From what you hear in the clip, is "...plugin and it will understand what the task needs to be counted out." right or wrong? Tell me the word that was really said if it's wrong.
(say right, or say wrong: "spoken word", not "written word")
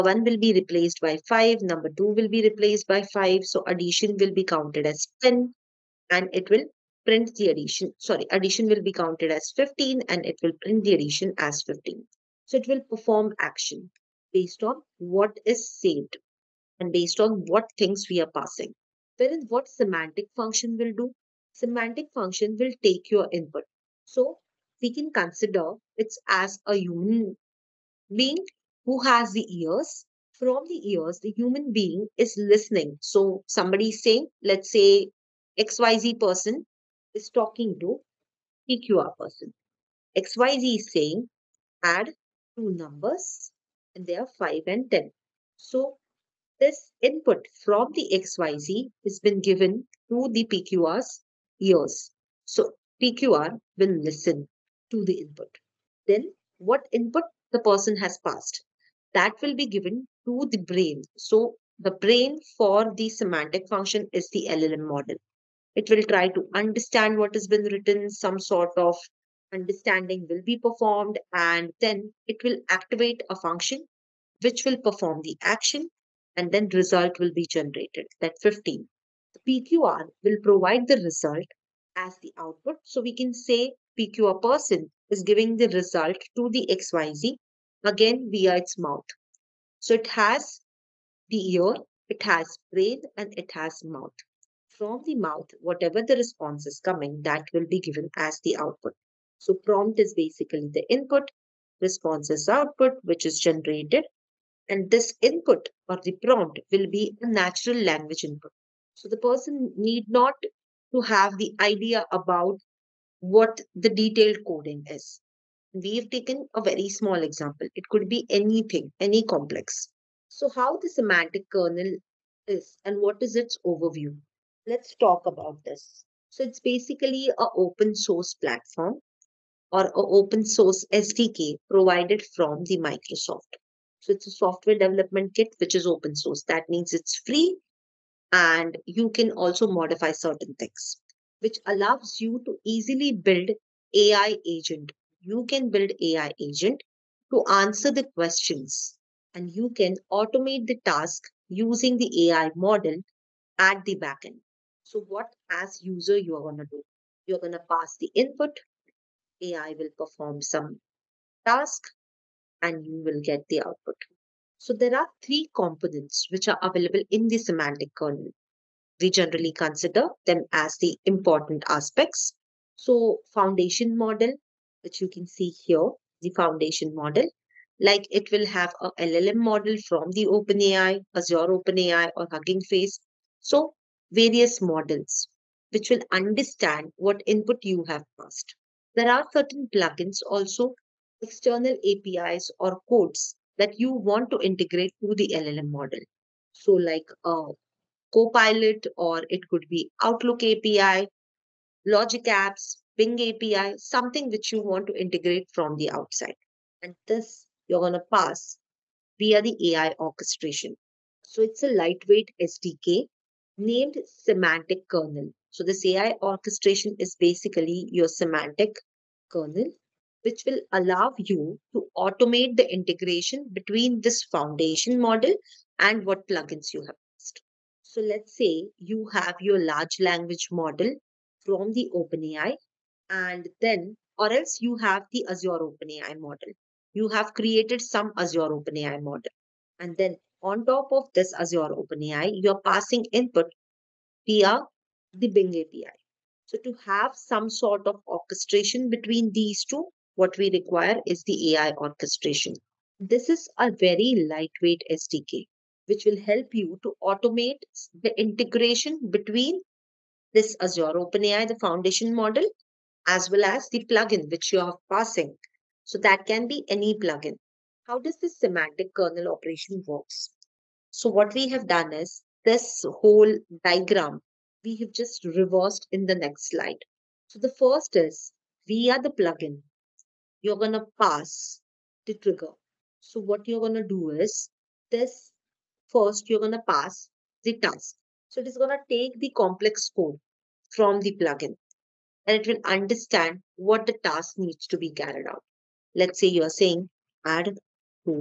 wrong: "carried", not "counted".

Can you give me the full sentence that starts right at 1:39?
So prompt is basically the input, response is output, which is generated.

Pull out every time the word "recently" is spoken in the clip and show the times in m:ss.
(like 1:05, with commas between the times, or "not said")
not said.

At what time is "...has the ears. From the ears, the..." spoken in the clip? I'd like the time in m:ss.
0:29.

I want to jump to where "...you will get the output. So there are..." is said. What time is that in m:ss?
2:42.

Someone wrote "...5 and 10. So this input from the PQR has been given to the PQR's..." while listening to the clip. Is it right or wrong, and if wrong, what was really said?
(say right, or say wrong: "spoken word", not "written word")
wrong: "XYZ", not "PQR".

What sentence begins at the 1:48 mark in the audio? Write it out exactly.
So the person need not to have the idea about what the detailed coding is.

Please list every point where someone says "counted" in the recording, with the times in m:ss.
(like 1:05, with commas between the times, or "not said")
0:04, 0:08.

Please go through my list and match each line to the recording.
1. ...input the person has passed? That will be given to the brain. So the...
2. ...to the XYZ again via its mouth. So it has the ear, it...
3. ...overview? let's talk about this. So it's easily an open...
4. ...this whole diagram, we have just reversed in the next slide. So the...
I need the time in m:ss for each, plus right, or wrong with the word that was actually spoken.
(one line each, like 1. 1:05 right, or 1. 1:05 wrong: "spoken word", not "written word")
1. 0:56 right
2. 1:26 right
3. 2:03 wrong: "basically", not "easily"
4. 4:32 right.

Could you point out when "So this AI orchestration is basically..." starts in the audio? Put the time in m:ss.
3:35.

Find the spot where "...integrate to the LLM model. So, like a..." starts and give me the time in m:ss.
3:14.